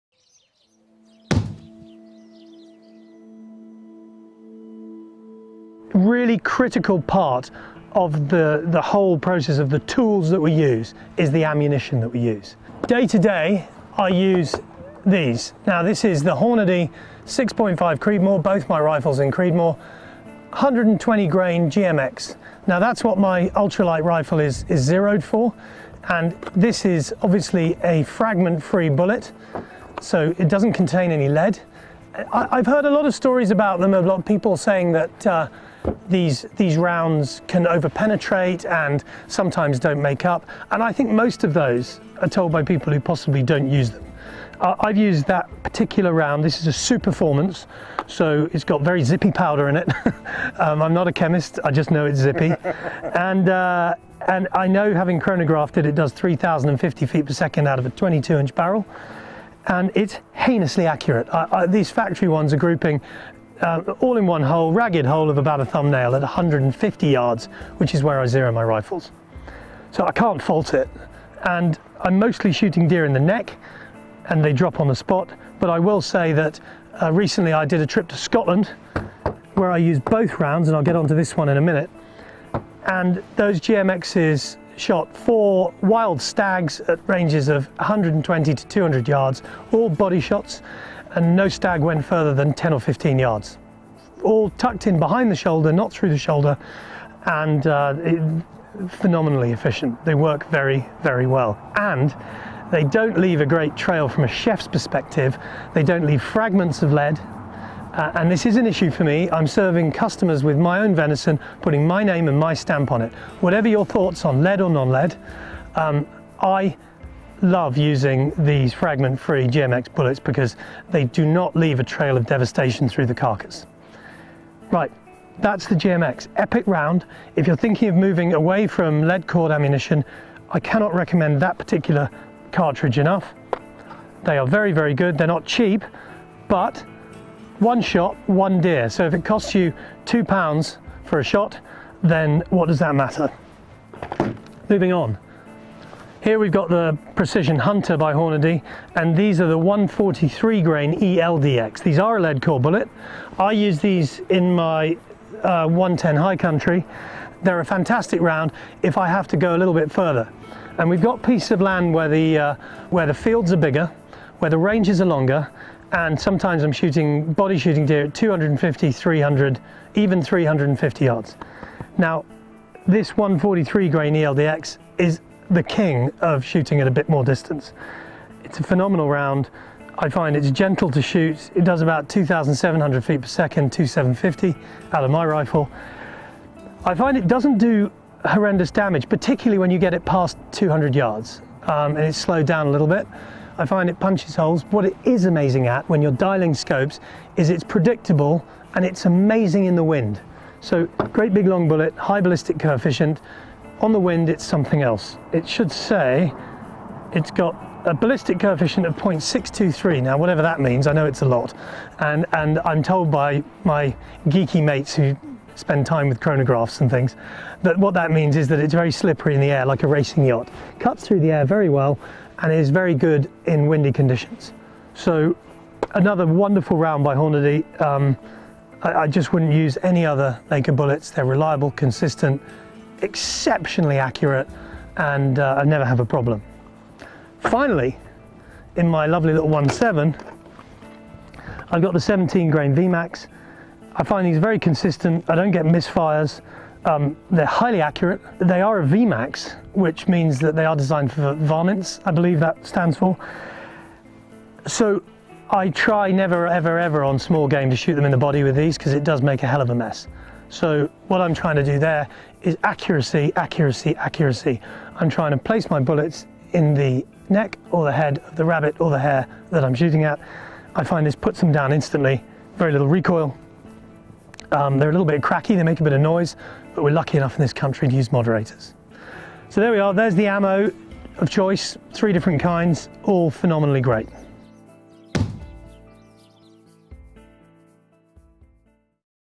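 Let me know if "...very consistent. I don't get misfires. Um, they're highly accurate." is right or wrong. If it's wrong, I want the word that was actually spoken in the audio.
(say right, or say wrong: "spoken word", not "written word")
right.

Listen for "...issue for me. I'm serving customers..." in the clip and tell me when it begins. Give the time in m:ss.
1:48.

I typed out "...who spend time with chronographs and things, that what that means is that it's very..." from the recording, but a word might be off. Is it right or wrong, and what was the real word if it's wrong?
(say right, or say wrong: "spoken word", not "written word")
right.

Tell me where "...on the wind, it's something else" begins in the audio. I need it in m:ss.
3:23.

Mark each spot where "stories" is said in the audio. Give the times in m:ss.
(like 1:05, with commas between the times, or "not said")
0:33.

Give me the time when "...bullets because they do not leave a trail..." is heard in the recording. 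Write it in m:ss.
1:59.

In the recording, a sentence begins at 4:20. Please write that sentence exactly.
So what I'm trying to do there is accuracy, accuracy, accuracy.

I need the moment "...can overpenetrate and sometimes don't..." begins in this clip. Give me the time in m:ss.
0:37.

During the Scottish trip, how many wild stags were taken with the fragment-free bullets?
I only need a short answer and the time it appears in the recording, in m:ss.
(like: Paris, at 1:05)
4, at 1:25.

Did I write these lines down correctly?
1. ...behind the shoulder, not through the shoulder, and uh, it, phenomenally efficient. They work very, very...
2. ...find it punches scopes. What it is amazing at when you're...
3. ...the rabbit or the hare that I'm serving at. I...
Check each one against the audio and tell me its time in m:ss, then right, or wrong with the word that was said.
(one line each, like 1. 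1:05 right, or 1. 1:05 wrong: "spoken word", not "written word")
1. 1:34 right
2. 3:13 wrong: "holes", not "scopes"
3. 4:28 wrong: "shooting", not "serving".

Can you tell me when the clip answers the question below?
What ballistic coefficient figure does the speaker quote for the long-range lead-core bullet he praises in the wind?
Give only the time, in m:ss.
3:28.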